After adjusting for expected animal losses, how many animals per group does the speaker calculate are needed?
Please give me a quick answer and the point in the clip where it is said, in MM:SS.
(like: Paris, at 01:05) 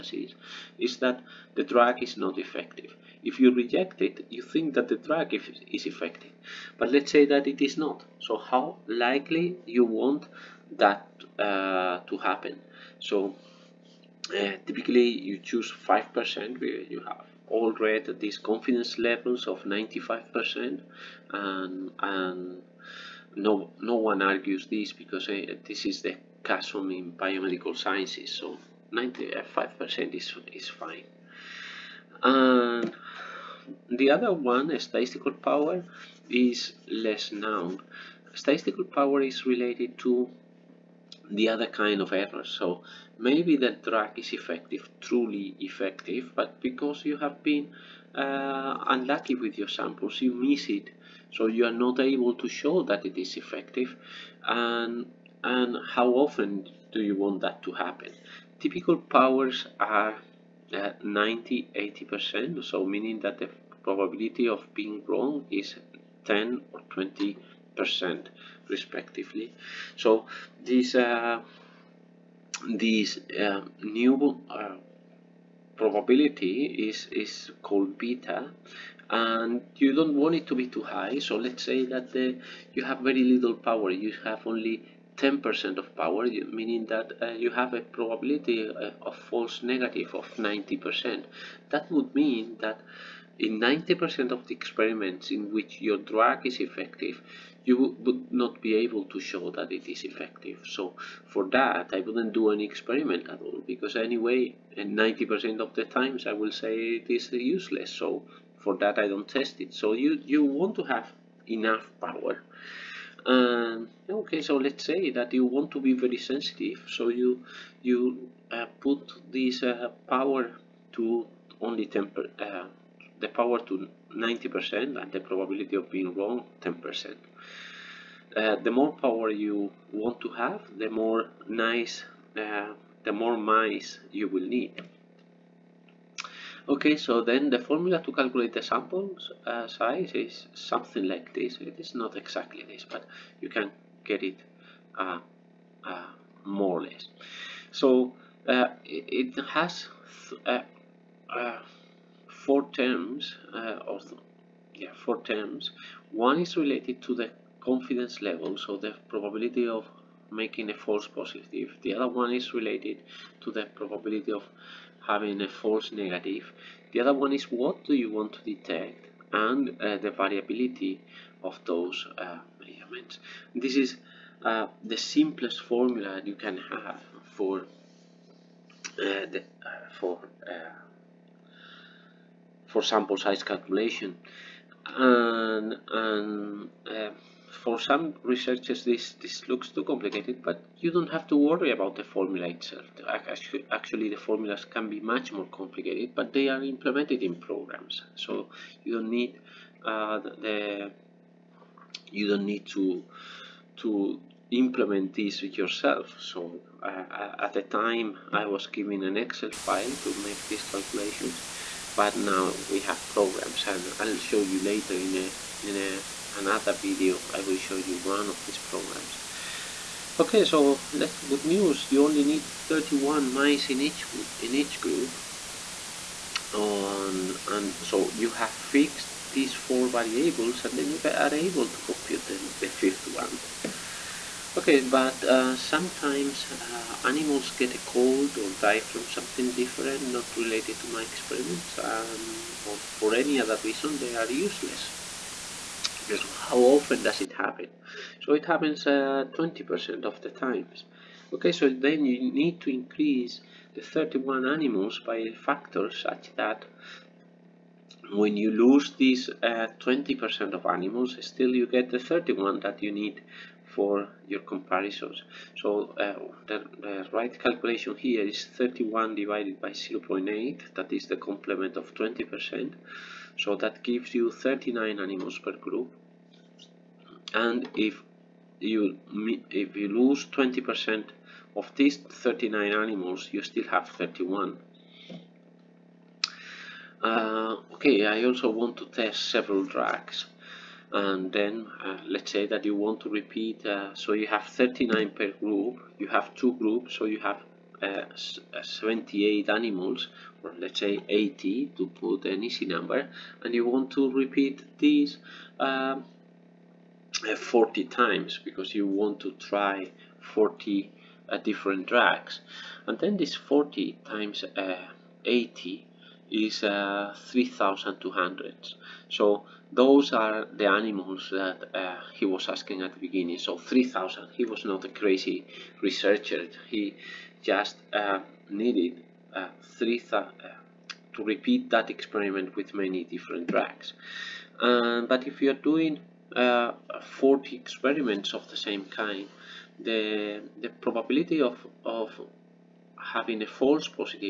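39, at 04:34.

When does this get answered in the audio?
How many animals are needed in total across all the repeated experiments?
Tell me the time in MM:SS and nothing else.
05:16.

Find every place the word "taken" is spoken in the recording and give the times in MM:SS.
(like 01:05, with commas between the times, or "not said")
not said.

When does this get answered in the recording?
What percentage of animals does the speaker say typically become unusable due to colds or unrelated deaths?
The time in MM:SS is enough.
04:08.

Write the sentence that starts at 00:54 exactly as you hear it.
And, and how often do you want that to happen?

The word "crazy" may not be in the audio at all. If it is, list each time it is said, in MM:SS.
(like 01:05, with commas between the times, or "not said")
05:24.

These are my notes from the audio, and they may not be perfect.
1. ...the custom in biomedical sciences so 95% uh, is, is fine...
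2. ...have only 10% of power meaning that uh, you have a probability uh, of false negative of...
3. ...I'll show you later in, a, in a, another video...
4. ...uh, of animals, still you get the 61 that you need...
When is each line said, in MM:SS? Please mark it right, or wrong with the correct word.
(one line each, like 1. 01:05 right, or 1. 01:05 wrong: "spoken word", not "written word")
1. 00:26 right
2. 01:24 right
3. 03:33 right
4. 04:20 wrong: "31", not "61".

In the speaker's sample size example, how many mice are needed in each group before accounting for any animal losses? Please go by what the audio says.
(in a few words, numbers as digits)
31.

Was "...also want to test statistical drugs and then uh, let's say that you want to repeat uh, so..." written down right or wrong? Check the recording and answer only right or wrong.
wrong.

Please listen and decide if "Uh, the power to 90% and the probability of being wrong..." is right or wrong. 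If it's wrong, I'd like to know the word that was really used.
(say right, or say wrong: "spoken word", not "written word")
right.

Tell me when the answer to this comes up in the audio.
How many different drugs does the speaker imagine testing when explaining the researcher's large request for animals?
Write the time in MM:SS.
05:10.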